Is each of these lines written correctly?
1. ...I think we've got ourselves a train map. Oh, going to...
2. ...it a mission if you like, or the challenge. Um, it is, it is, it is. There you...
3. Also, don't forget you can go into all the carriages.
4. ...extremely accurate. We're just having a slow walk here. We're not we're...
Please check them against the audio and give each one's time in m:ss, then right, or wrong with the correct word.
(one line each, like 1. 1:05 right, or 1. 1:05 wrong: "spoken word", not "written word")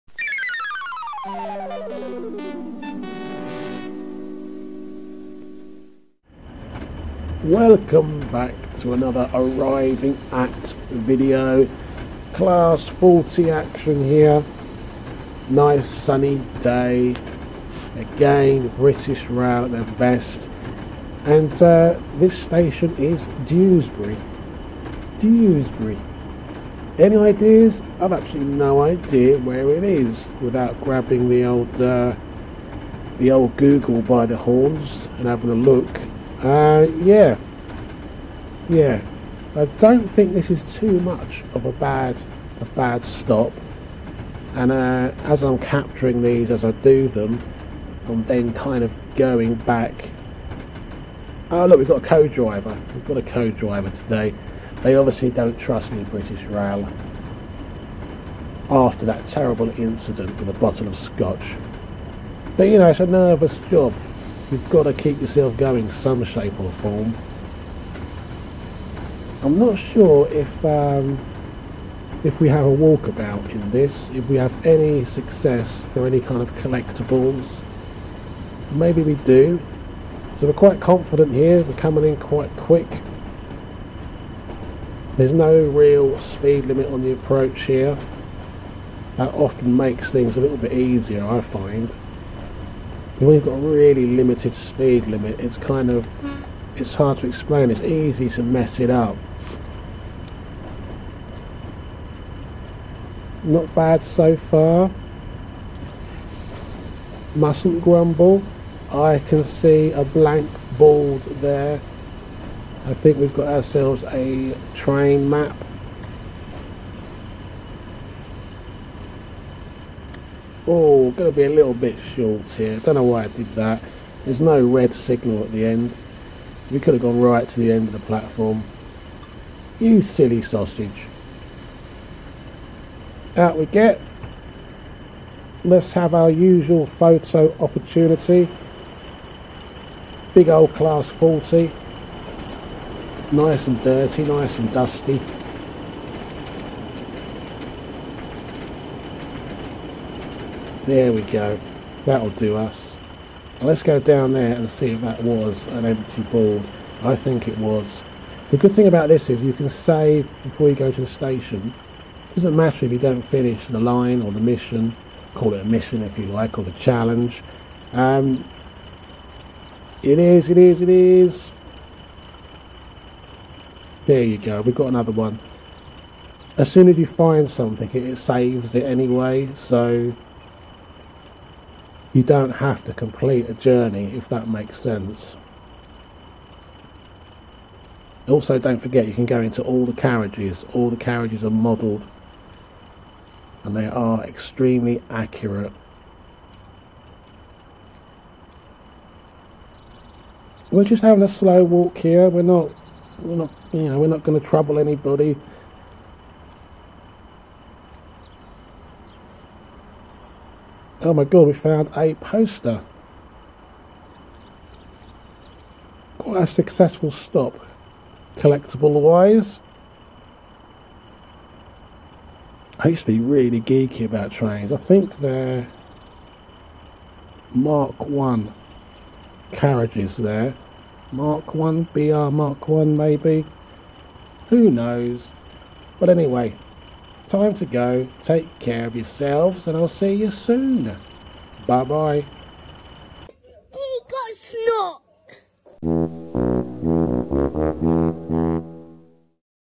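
1. 1:52 right
2. 2:45 right
3. 3:08 right
4. 3:14 right.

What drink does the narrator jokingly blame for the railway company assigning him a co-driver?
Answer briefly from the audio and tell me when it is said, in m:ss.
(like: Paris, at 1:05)
Scotch, at 1:00.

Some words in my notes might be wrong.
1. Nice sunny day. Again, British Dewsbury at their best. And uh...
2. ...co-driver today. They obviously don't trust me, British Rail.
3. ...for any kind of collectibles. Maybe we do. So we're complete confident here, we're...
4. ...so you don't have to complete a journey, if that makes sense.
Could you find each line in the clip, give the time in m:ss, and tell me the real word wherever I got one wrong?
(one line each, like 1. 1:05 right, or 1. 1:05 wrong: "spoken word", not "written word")
1. 0:15 wrong: "Rail", not "Dewsbury"
2. 0:53 right
3. 1:15 wrong: "quite", not "complete"
4. 2:59 right.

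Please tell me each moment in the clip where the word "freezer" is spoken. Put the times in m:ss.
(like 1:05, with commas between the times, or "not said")
not said.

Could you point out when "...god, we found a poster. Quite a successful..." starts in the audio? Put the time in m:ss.
3:31.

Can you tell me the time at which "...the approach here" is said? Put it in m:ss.
1:27.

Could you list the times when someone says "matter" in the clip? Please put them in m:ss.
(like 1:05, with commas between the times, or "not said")
2:42.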